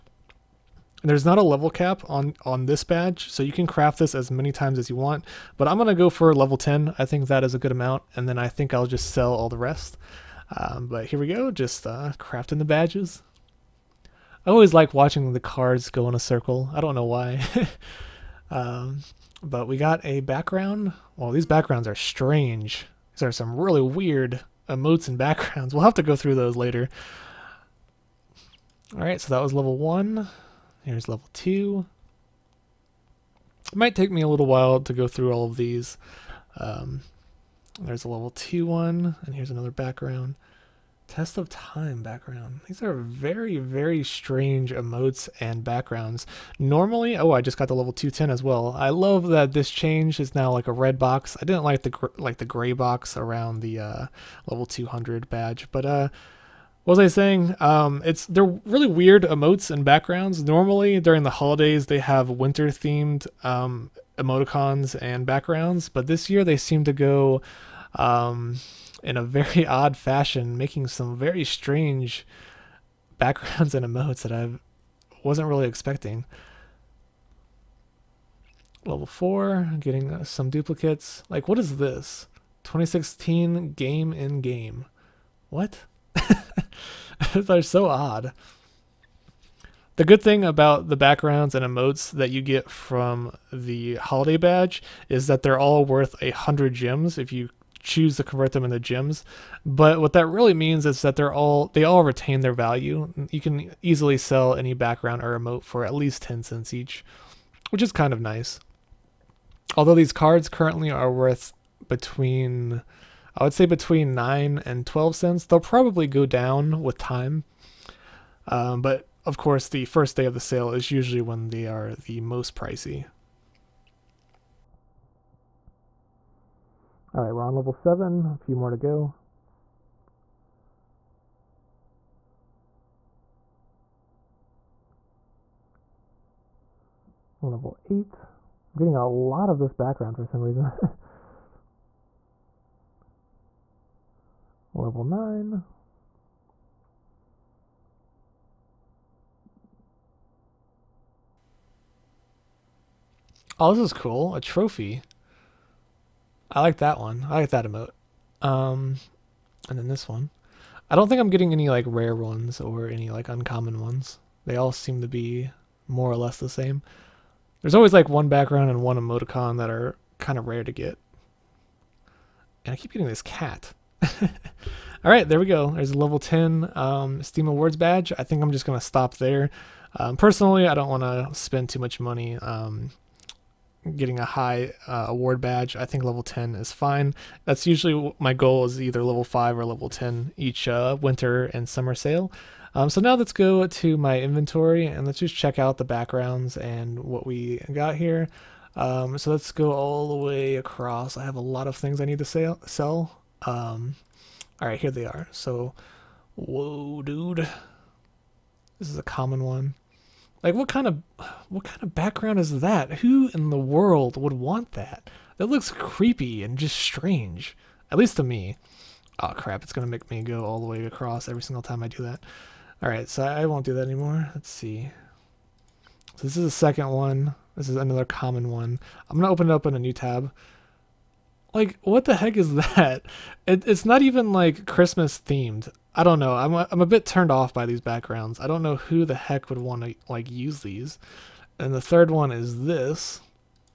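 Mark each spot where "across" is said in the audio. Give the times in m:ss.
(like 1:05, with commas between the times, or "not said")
3:20, 3:40.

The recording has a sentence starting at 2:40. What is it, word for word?
I don't think I'm getting any like rare ones or any like uncommon ones.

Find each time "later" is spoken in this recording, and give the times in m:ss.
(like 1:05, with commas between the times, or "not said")
0:26.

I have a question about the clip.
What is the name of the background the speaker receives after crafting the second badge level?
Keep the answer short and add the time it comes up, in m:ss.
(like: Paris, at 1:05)
Test of Time, at 0:41.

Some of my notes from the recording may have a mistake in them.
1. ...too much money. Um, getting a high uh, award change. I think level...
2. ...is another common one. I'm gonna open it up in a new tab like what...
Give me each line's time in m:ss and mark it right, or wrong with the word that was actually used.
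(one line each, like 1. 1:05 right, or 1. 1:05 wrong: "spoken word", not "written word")
1. 3:01 wrong: "badge", not "change"
2. 3:47 right.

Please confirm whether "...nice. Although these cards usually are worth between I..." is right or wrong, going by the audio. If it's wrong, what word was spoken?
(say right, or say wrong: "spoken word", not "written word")
wrong: "currently", not "usually".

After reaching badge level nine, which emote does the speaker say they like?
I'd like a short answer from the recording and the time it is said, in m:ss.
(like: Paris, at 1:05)
A trophy, at 2:34.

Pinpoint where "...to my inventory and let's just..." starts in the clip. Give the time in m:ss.
3:13.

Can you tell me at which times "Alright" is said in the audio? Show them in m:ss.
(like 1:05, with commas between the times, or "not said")
0:28, 3:42.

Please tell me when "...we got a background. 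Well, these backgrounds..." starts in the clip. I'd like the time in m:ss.
0:19.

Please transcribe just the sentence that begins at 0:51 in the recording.
I didn't like the like the gray box around the uh, level 200 badge, but uh, what was I saying?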